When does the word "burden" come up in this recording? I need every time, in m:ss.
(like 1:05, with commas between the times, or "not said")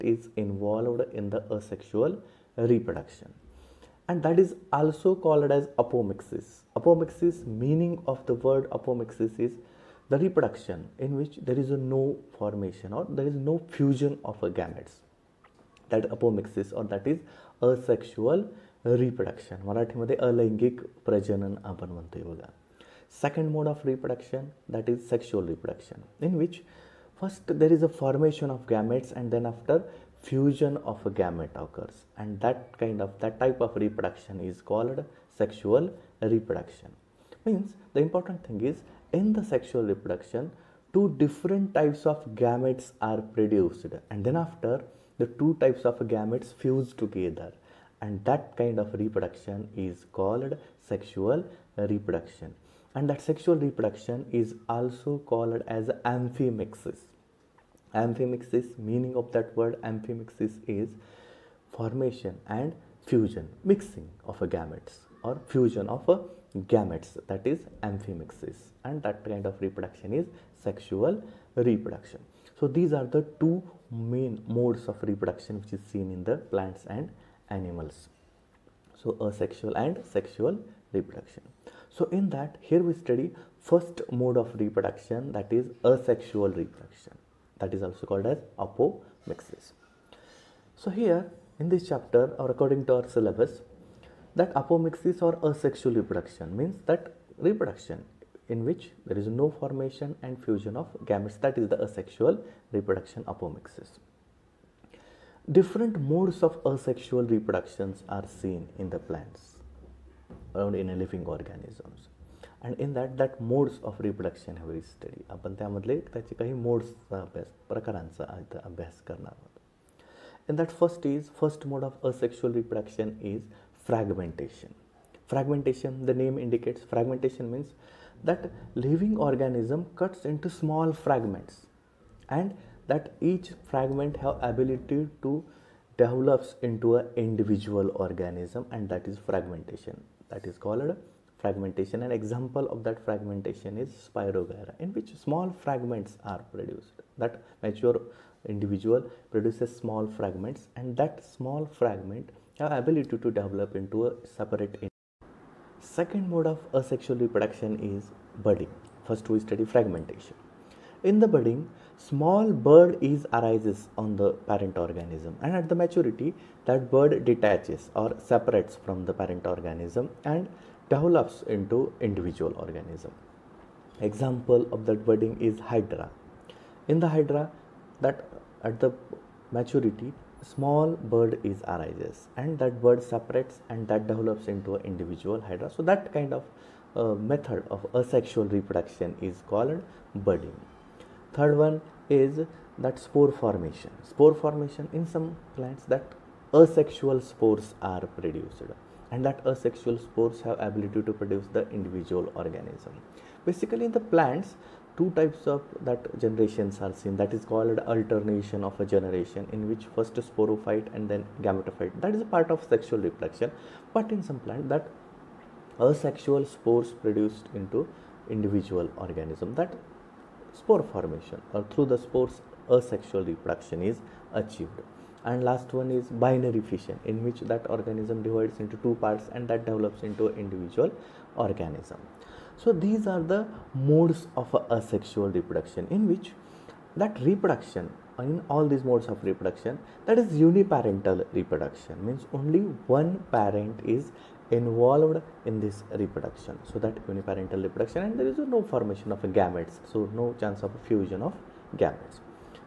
not said.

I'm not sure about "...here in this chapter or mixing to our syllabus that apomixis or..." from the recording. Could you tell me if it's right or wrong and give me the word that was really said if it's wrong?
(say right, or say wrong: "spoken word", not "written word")
wrong: "according", not "mixing".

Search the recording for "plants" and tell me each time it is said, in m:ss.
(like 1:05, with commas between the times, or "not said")
1:16, 1:48, 3:15, 3:24, 3:34.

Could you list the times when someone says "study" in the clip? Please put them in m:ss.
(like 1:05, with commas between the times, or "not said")
1:22, 2:39.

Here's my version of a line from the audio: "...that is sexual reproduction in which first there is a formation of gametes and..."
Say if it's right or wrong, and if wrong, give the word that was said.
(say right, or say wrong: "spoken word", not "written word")
right.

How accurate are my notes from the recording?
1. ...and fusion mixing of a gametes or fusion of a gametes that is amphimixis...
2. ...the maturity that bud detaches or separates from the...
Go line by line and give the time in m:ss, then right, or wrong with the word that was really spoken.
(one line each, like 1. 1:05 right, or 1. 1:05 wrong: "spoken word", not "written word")
1. 1:02 right
2. 2:45 right.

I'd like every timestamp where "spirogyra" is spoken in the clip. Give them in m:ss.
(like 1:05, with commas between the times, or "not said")
2:24.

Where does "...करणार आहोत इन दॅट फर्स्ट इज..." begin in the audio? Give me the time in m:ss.
1:59.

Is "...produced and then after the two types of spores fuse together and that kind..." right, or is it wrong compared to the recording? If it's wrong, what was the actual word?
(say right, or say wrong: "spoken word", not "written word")
wrong: "gametes", not "spores".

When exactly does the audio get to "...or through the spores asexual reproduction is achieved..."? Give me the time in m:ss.
3:41.